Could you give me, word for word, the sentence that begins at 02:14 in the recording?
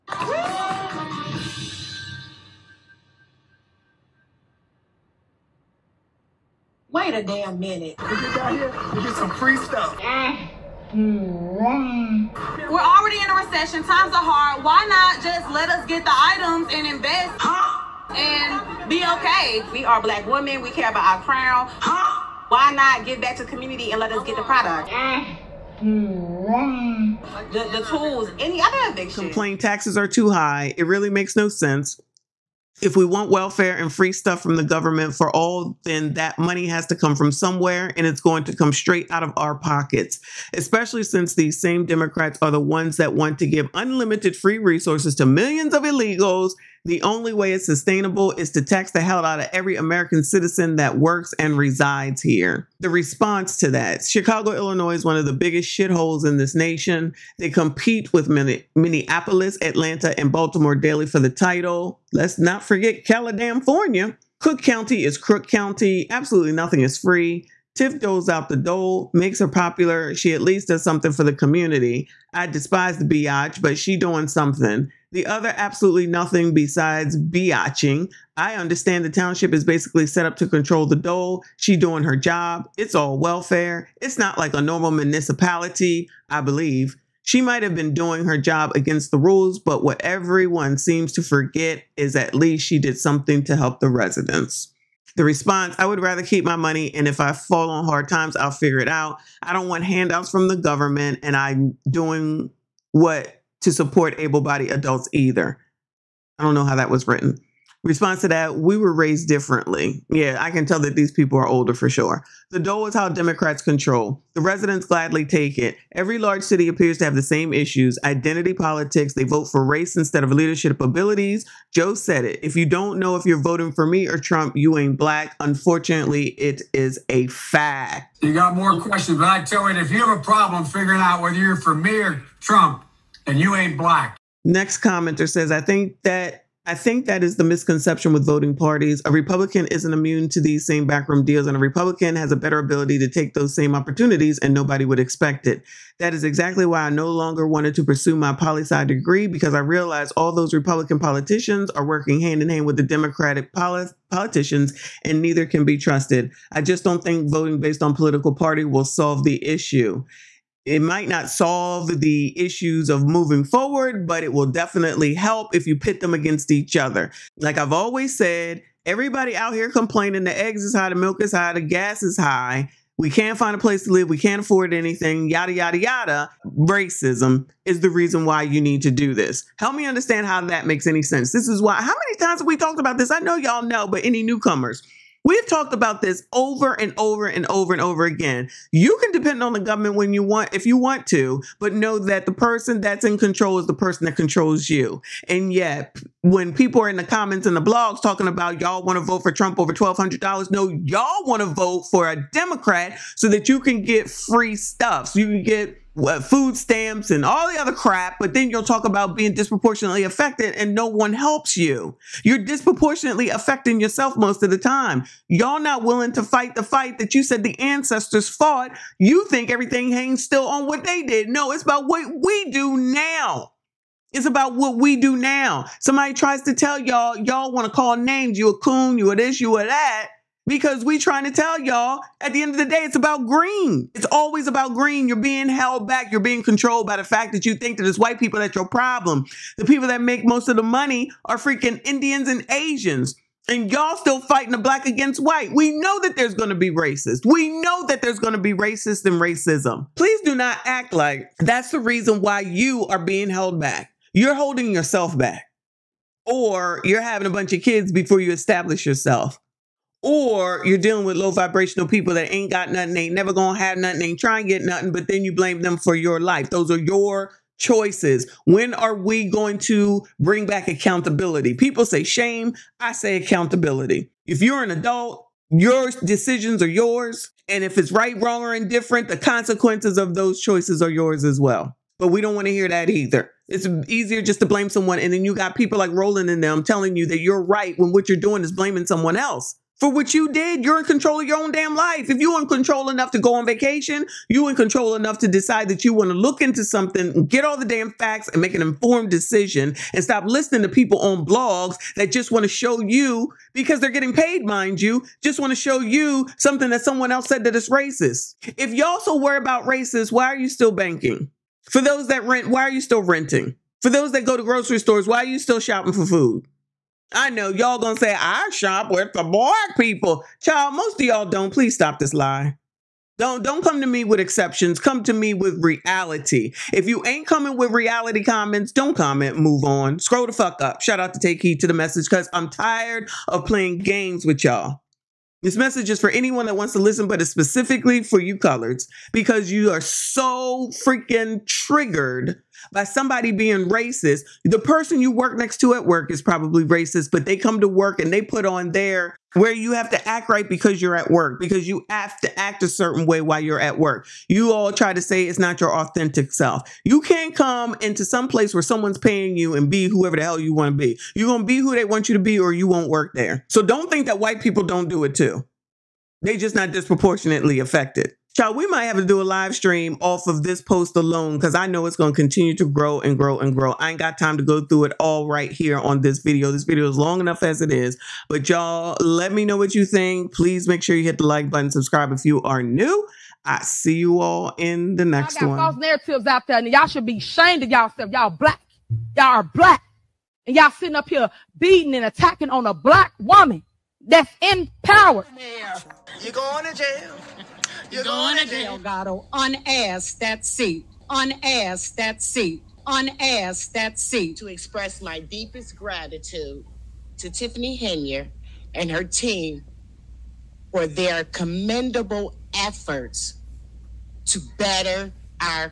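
Next commenter says, I think that I think that is the misconception with voting parties.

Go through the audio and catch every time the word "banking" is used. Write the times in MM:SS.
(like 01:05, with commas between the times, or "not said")
05:10.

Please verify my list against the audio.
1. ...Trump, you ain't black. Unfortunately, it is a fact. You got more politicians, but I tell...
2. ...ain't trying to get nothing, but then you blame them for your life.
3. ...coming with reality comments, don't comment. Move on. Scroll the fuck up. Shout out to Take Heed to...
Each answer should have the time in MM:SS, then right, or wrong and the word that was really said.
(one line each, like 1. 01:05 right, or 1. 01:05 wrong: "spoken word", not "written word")
1. 02:04 wrong: "questions", not "politicians"
2. 04:24 right
3. 05:27 right.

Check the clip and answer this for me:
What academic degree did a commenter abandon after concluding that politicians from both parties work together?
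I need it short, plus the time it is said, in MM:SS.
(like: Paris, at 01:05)
Poli sci degree, at 02:28.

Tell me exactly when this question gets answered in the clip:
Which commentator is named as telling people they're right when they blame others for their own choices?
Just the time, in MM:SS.
04:45.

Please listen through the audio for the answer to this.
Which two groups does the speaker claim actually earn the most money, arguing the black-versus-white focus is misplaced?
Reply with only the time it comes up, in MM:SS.
04:01.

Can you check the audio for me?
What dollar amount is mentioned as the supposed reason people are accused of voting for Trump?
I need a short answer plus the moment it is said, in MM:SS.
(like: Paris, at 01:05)
$1,200, at 03:19.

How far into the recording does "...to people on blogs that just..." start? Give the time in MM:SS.
05:00.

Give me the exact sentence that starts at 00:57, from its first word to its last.
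They compete with Minneapolis, Atlanta, and Baltimore daily for the title.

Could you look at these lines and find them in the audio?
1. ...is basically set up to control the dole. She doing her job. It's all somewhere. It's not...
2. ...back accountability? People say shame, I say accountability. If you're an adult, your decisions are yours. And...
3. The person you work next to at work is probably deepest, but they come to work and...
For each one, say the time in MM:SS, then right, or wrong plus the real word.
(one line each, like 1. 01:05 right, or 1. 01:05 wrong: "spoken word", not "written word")
1. 01:19 wrong: "welfare", not "somewhere"
2. 04:30 right
3. 05:44 wrong: "racist", not "deepest".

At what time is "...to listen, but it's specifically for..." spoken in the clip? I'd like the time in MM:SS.
05:36.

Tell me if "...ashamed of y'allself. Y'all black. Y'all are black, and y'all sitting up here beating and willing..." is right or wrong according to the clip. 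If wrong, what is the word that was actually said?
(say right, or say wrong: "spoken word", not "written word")
wrong: "attacking", not "willing".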